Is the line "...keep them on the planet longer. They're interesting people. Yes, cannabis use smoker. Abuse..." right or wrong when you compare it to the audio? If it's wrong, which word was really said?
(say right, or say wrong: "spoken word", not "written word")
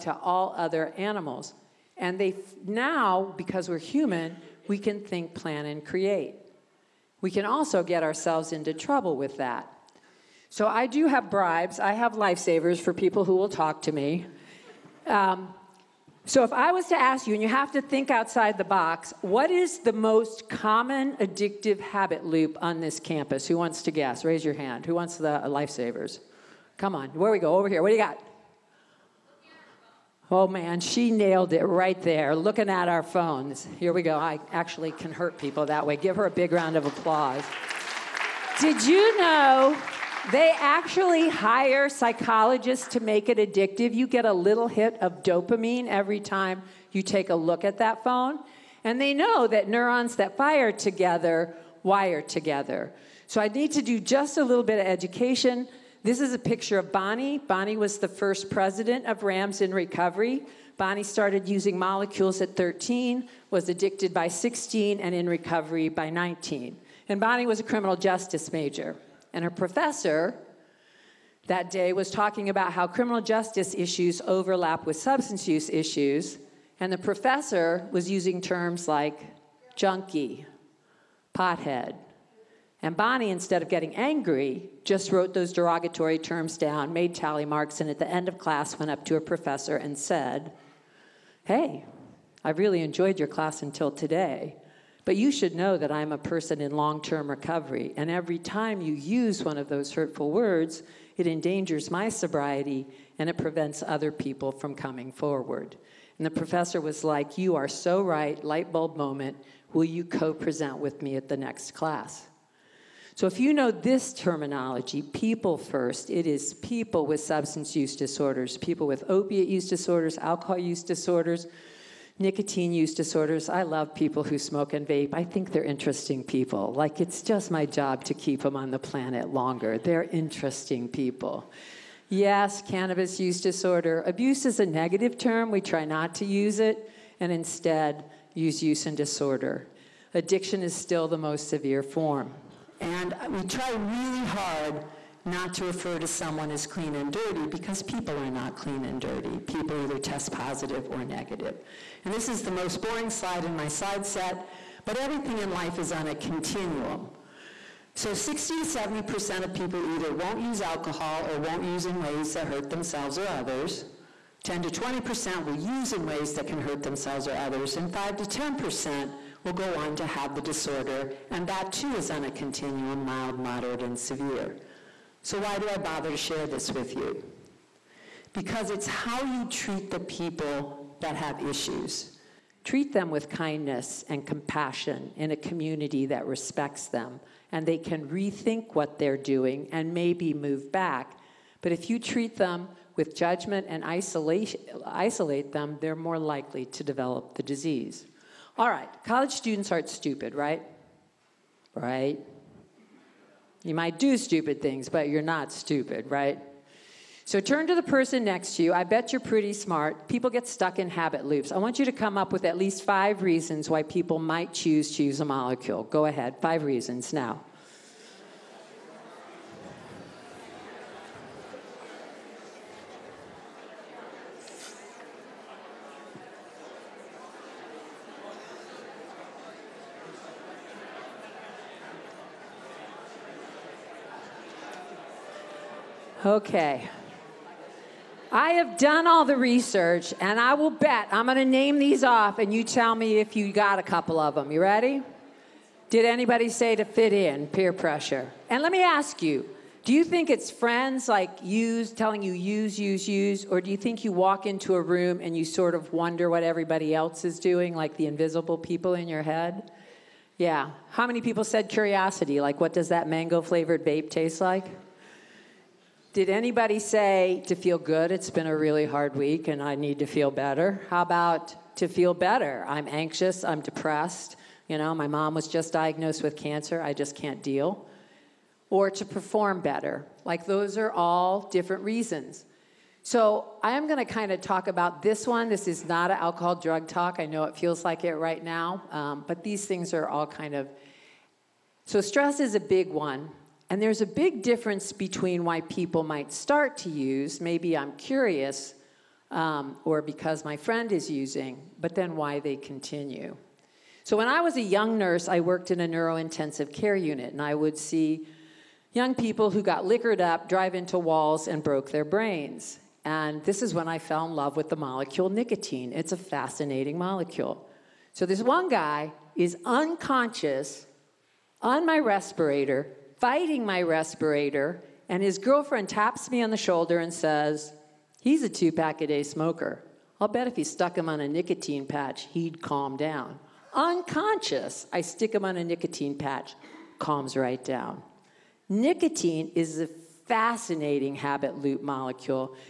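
wrong: "disorder", not "smoker".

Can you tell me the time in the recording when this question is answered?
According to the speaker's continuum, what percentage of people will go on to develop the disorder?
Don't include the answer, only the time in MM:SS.
02:47.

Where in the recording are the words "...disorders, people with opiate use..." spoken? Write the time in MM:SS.
01:57.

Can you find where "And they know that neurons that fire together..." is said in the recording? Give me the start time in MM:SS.
00:48.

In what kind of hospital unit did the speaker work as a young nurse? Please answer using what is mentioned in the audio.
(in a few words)
Neurointensive care unit.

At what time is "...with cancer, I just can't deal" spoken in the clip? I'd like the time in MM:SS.
04:36.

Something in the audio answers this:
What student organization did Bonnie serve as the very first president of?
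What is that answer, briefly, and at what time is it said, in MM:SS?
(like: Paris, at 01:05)
Rams in Recovery, at 00:59.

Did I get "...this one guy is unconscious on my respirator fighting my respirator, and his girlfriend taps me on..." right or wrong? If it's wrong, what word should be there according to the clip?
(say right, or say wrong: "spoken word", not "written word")
right.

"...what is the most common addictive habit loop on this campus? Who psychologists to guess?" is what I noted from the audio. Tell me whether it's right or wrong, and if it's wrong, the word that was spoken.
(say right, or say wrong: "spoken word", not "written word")
wrong: "wants", not "psychologists".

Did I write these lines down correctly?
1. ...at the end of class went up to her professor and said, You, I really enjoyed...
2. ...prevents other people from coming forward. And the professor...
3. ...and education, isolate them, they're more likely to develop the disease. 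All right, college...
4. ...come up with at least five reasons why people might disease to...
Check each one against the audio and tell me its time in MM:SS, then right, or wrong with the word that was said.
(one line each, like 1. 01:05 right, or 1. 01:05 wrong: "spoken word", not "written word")
1. 01:27 wrong: "Hey", not "You"
2. 01:43 right
3. 03:13 wrong: "isolation", not "education"
4. 03:31 wrong: "choose", not "disease".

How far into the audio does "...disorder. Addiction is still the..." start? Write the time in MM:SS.
02:18.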